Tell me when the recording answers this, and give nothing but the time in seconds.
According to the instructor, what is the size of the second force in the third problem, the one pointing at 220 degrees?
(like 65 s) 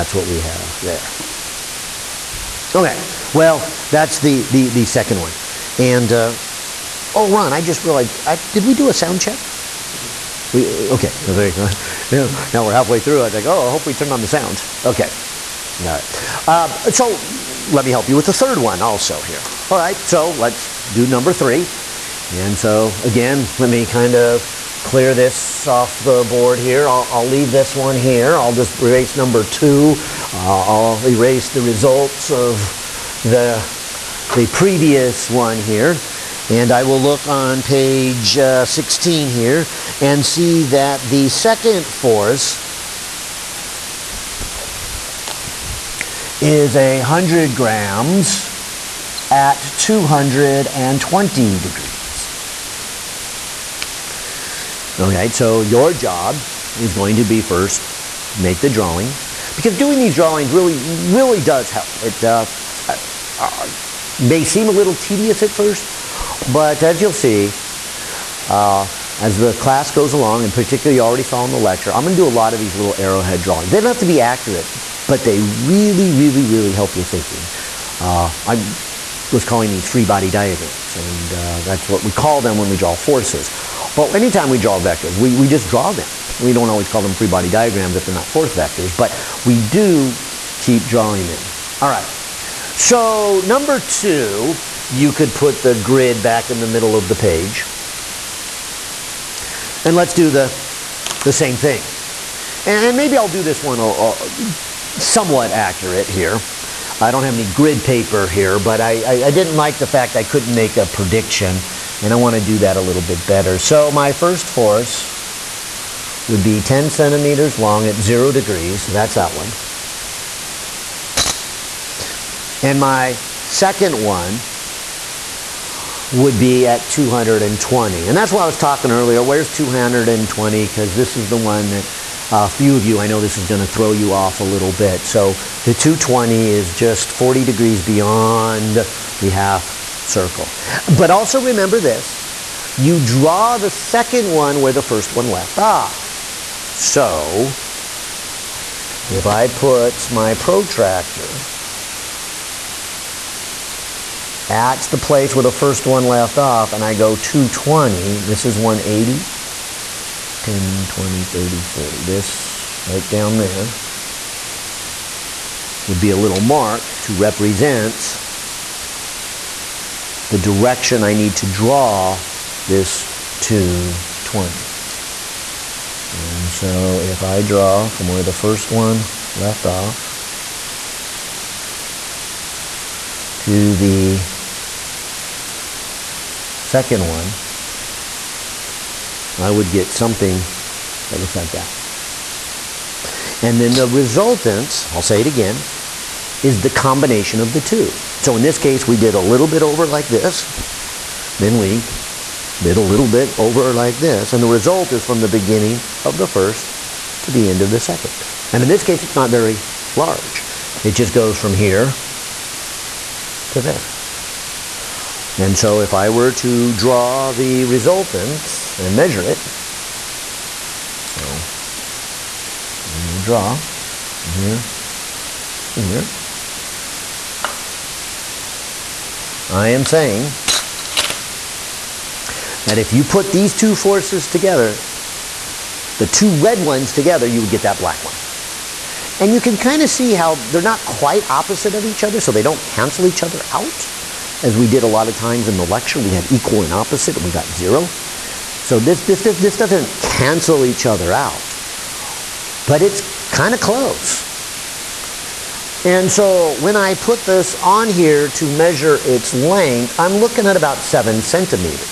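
46 s.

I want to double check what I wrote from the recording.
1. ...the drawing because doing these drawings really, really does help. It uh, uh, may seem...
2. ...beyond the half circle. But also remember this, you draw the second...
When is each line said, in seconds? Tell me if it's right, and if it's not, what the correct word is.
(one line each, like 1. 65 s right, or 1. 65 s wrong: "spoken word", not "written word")
1. 58 s right
2. 137 s right.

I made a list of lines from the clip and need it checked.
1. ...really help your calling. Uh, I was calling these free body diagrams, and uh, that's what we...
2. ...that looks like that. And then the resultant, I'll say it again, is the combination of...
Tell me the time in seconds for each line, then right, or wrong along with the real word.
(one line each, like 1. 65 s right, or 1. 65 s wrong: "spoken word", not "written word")
1. 76 s wrong: "thinking", not "calling"
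2. 191 s right.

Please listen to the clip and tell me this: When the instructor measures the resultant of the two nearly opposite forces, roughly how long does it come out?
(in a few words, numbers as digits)
7 centimeters.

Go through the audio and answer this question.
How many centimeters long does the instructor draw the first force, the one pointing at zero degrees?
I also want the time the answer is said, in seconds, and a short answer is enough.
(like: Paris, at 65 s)
10, at 116 s.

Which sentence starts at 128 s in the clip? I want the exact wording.
And that's why I was talking earlier.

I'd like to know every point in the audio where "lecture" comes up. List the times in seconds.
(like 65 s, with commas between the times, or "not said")
71 s, 245 s.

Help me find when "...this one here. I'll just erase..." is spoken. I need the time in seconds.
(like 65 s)
27 s.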